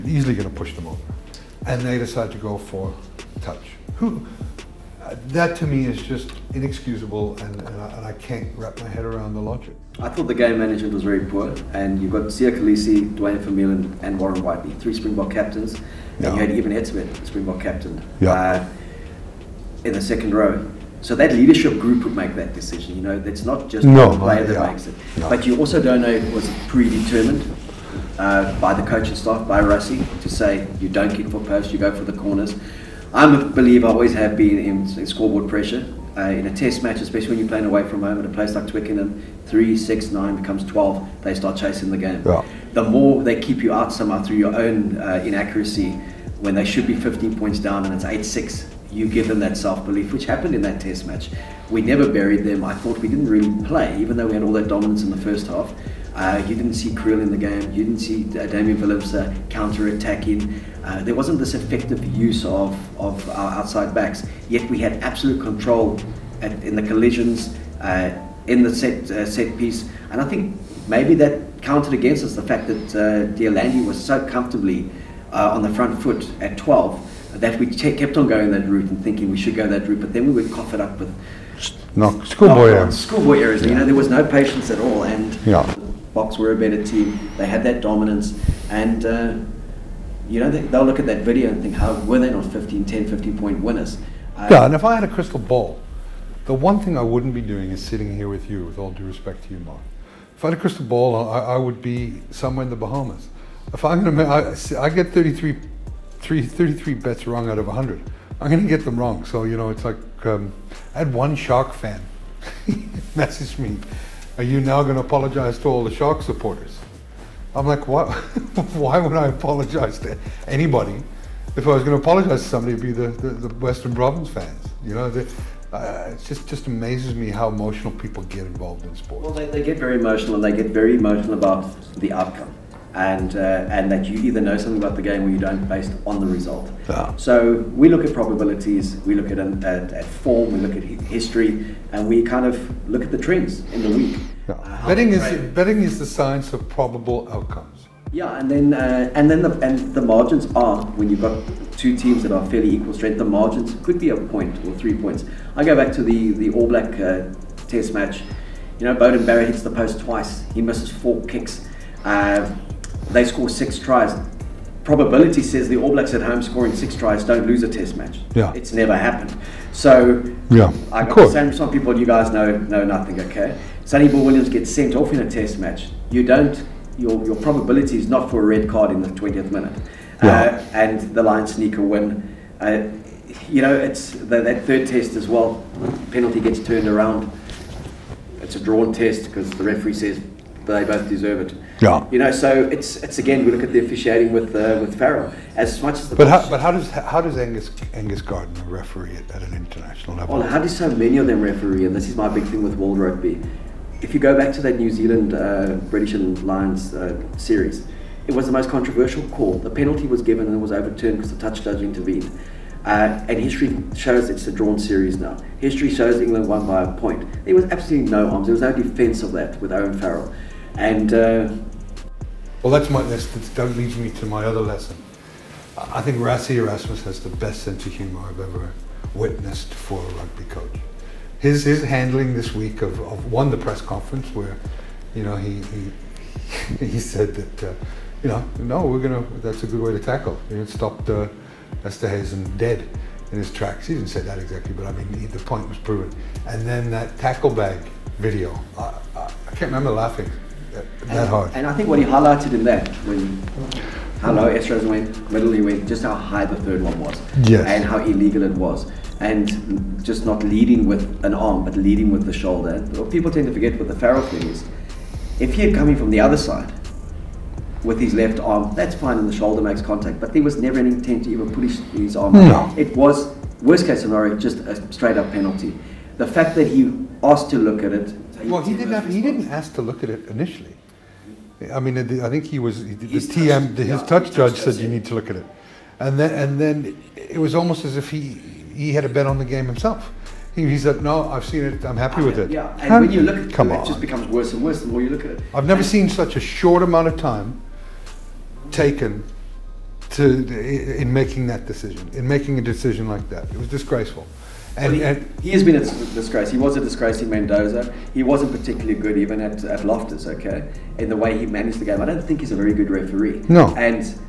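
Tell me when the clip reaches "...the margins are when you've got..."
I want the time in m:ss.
2:29.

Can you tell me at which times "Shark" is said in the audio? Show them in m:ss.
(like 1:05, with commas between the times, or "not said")
1:51, 1:55.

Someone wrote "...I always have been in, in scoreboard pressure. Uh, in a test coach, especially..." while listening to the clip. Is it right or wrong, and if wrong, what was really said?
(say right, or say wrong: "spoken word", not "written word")
wrong: "match", not "coach".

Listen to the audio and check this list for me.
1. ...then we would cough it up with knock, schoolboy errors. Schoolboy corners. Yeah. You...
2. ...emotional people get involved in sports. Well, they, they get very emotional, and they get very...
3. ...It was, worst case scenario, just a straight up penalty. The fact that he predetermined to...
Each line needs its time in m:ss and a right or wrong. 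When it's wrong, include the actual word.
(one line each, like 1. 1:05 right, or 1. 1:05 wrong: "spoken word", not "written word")
1. 1:20 wrong: "errors", not "corners"
2. 2:07 right
3. 4:32 wrong: "asked", not "predetermined".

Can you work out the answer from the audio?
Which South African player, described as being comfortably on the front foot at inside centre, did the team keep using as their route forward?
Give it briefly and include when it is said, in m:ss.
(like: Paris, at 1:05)
Landy, at 1:13.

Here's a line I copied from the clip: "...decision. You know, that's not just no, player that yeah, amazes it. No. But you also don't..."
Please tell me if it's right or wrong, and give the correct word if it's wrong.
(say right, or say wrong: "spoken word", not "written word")
wrong: "makes", not "amazes".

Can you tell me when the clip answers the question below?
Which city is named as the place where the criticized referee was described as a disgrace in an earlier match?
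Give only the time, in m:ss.
5:07.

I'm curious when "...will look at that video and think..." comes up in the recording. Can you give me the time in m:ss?
1:30.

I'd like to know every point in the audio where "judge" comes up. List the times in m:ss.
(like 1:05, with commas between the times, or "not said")
3:31, 4:44.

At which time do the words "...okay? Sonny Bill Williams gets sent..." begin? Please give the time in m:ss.
2:53.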